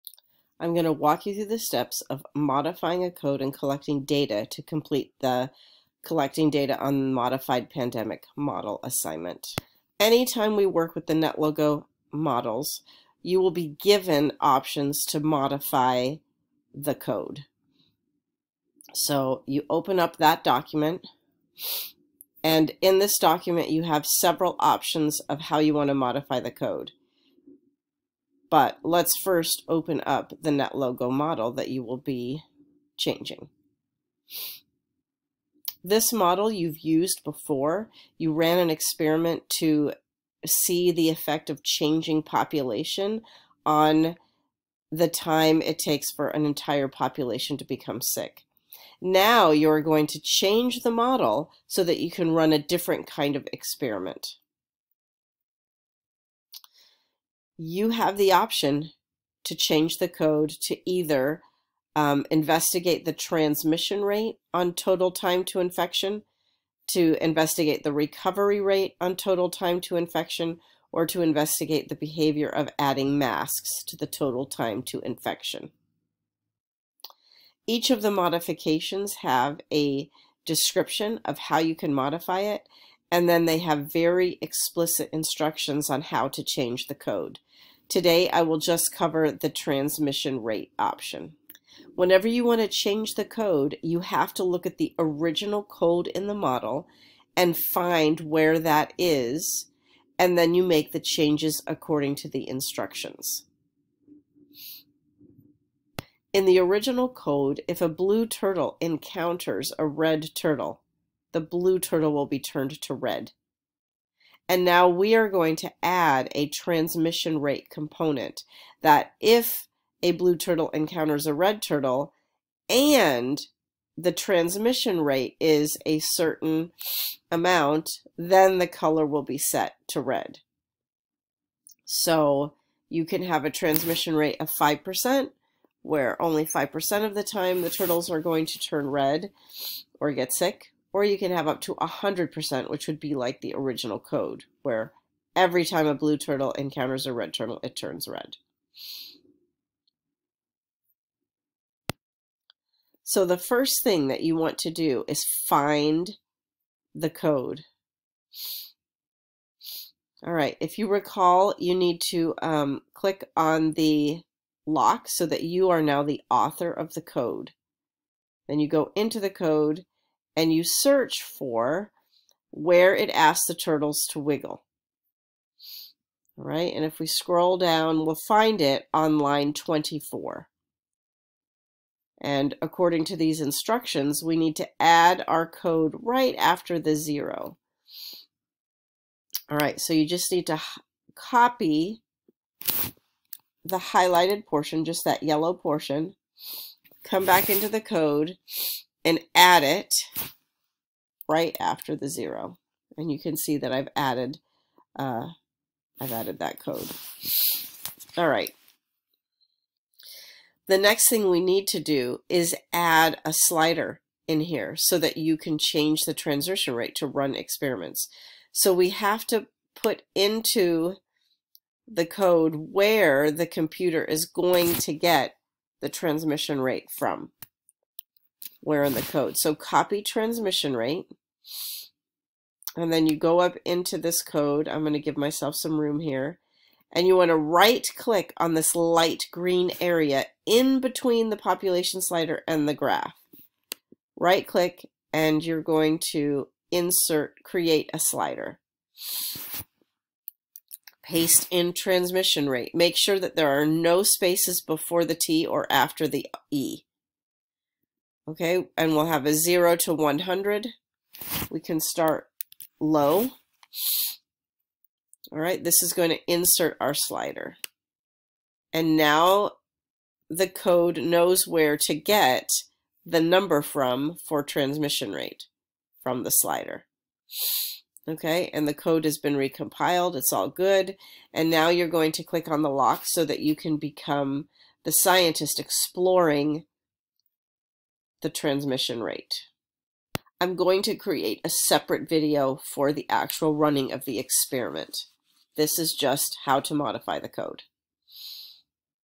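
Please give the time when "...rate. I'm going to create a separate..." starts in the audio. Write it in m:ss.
4:49.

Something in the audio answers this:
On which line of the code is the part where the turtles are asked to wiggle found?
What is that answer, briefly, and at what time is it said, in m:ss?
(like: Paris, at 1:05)
24, at 2:59.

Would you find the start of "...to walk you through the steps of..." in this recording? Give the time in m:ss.
0:00.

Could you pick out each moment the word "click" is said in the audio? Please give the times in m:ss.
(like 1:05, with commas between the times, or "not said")
2:42, 3:57, 4:04, 4:42.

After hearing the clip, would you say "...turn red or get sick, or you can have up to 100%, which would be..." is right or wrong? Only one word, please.
right.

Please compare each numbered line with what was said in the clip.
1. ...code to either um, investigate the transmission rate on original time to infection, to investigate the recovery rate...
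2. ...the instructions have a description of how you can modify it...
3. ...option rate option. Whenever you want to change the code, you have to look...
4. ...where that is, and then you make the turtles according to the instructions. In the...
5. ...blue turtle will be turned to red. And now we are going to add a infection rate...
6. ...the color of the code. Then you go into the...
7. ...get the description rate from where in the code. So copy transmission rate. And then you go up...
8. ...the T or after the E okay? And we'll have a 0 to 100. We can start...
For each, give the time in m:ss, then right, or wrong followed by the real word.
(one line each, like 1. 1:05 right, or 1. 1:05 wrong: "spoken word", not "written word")
1. 1:00 wrong: "total", not "original"
2. 1:18 wrong: "modifications", not "instructions"
3. 1:29 wrong: "transmission", not "option"
4. 1:38 wrong: "changes", not "turtles"
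5. 1:51 wrong: "transmission", not "infection"
6. 2:46 wrong: "author", not "color"
7. 3:44 wrong: "transmission", not "description"
8. 4:15 right.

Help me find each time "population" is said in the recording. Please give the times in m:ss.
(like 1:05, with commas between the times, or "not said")
0:42, 0:46, 4:01.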